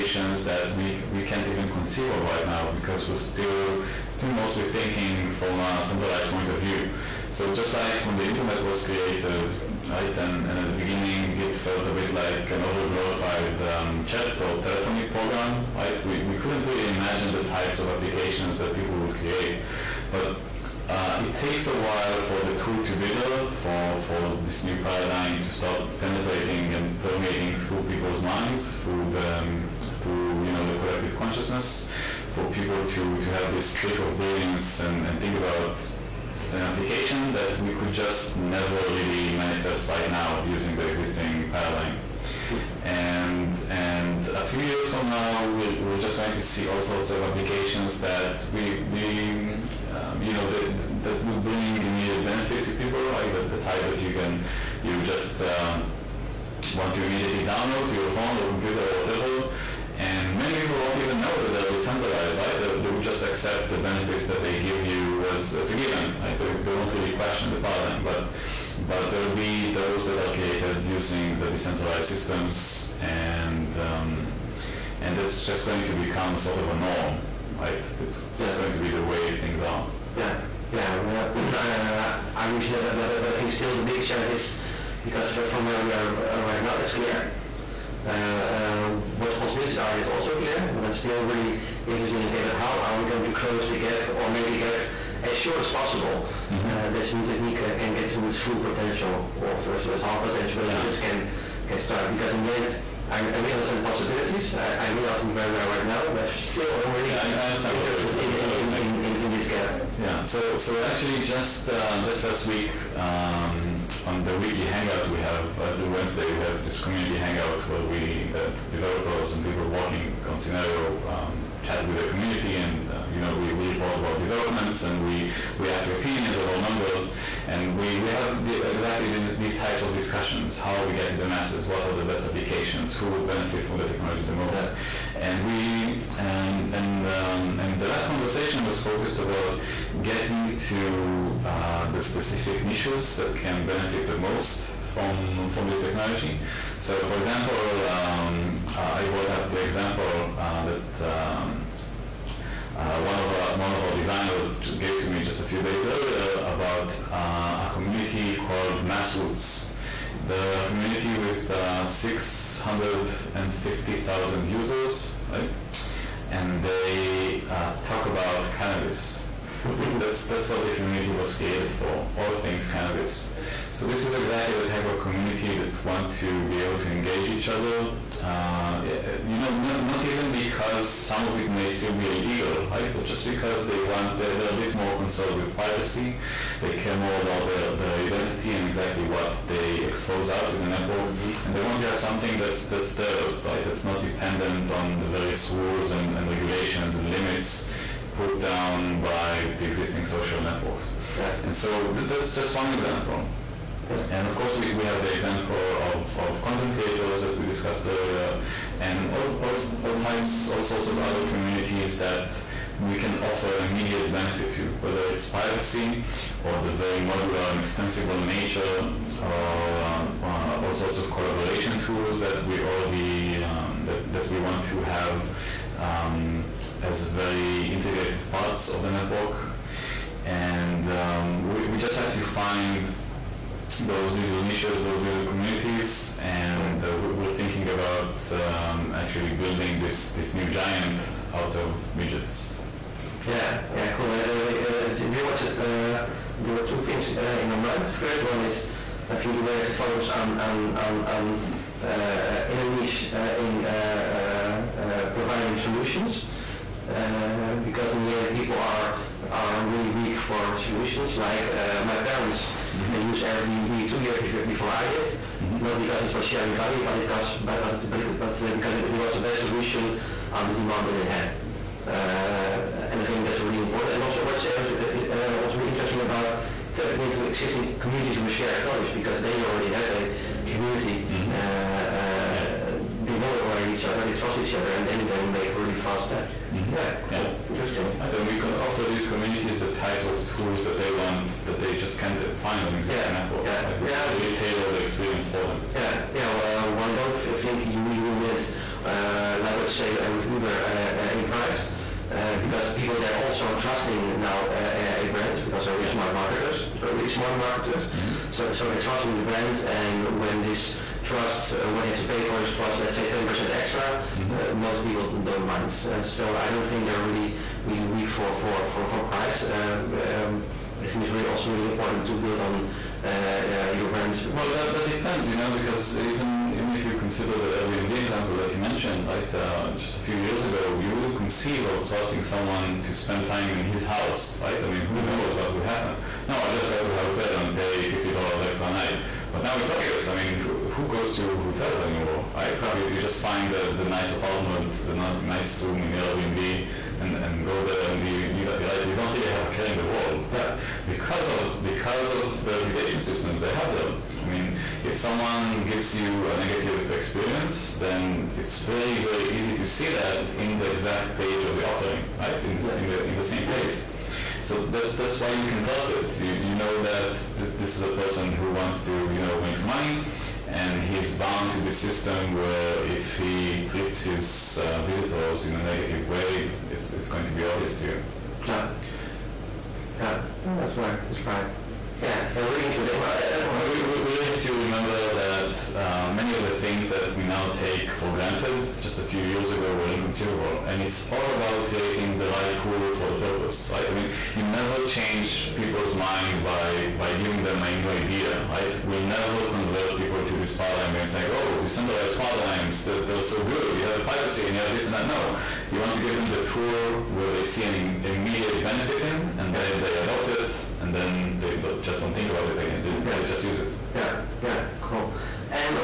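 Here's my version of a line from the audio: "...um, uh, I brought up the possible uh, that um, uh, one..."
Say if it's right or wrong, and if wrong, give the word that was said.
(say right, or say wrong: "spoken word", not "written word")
wrong: "example", not "possible".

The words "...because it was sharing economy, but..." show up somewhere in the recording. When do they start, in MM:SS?
04:25.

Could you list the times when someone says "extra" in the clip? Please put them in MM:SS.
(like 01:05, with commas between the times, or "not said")
05:13, 05:38.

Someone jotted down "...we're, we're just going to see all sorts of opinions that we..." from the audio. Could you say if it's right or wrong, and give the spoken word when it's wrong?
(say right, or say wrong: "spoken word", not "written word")
wrong: "applications", not "opinions".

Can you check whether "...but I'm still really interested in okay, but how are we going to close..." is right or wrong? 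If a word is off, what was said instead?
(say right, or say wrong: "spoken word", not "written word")
right.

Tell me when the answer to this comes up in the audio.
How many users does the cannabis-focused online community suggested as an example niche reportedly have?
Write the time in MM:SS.
02:41.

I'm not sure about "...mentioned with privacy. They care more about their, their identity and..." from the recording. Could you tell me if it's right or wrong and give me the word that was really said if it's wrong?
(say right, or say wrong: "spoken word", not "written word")
wrong: "concerned", not "mentioned".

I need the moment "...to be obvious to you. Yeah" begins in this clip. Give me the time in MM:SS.
06:17.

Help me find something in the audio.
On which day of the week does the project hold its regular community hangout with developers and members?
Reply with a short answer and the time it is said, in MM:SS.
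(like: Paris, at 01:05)
Wednesday, at 01:55.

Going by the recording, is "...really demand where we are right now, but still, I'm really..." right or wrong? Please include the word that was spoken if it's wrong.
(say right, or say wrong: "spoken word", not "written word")
wrong: "understand", not "demand".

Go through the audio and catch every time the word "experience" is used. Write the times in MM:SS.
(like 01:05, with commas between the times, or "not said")
04:54, 05:56.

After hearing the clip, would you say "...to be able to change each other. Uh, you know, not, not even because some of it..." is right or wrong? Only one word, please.
wrong.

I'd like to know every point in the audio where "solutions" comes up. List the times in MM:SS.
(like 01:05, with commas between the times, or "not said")
04:15, 04:20, 04:29.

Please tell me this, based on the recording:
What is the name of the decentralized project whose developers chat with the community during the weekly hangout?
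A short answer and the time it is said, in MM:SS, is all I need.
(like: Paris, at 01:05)
Synereo, at 02:00.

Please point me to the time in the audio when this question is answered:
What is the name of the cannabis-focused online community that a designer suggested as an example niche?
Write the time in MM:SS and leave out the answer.
02:38.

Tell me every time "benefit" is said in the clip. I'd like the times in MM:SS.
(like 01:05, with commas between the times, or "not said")
00:52, 01:03, 02:13, 02:23, 03:34, 06:48.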